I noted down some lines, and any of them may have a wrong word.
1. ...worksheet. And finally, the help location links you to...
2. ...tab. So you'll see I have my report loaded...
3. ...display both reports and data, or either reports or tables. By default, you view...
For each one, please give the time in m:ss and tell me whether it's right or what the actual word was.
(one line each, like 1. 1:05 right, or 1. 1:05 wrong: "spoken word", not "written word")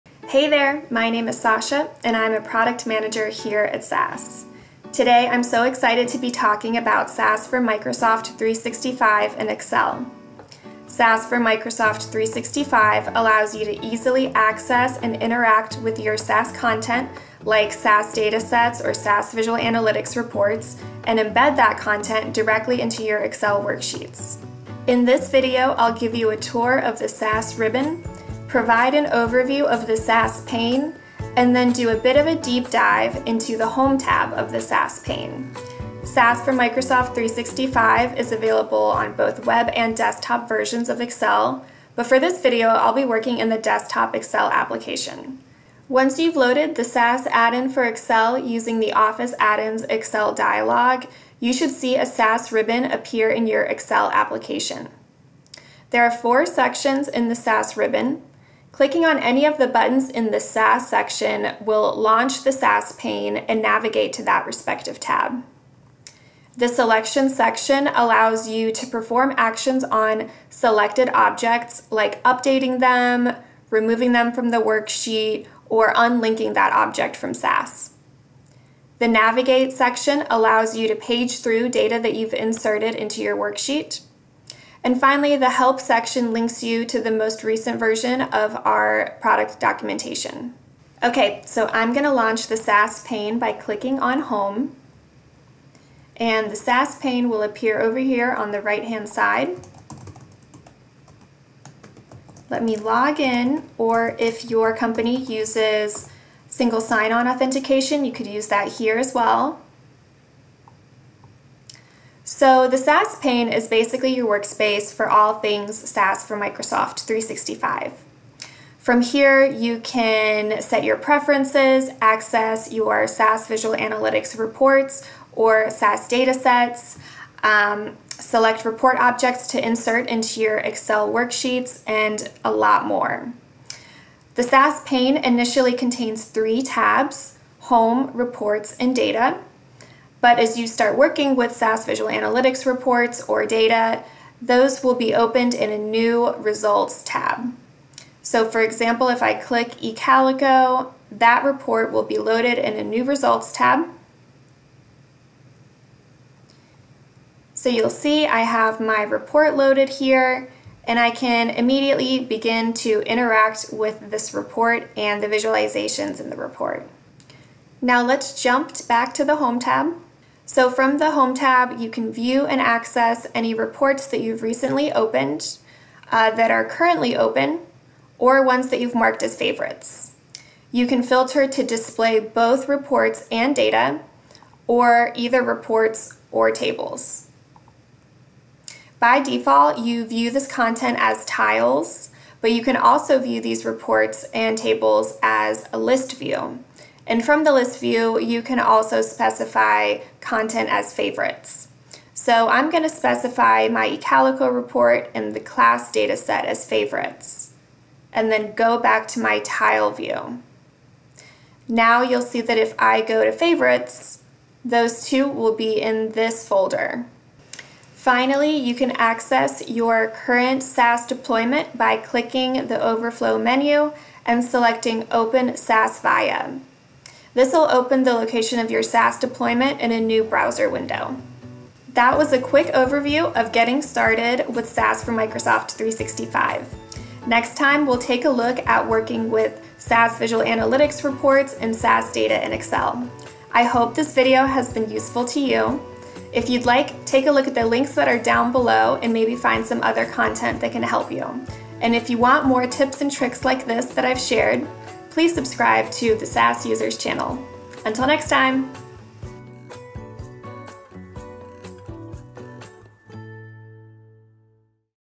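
1. 1:23 wrong: "section", not "location"
2. 2:33 right
3. 3:01 right.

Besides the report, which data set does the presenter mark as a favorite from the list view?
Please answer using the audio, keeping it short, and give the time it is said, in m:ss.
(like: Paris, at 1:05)
class, at 3:25.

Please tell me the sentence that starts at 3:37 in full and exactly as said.
Finally, you can access your current SAS deployment by clicking the overflow menu and selecting Open SAS Viya.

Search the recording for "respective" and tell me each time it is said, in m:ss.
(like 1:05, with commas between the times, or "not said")
1:04.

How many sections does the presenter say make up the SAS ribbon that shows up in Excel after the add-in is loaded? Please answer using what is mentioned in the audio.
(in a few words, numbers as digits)
4.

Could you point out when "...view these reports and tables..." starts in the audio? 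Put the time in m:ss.
3:13.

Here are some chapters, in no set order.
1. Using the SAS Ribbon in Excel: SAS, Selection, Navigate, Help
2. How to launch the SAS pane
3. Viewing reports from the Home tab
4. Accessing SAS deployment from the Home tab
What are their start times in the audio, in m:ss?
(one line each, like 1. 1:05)
1. 0:50
2. 1:34
3. 2:48
4. 3:40.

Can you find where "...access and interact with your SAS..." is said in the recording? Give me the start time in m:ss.
0:14.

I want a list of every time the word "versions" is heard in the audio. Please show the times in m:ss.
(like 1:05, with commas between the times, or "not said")
0:40, 1:27.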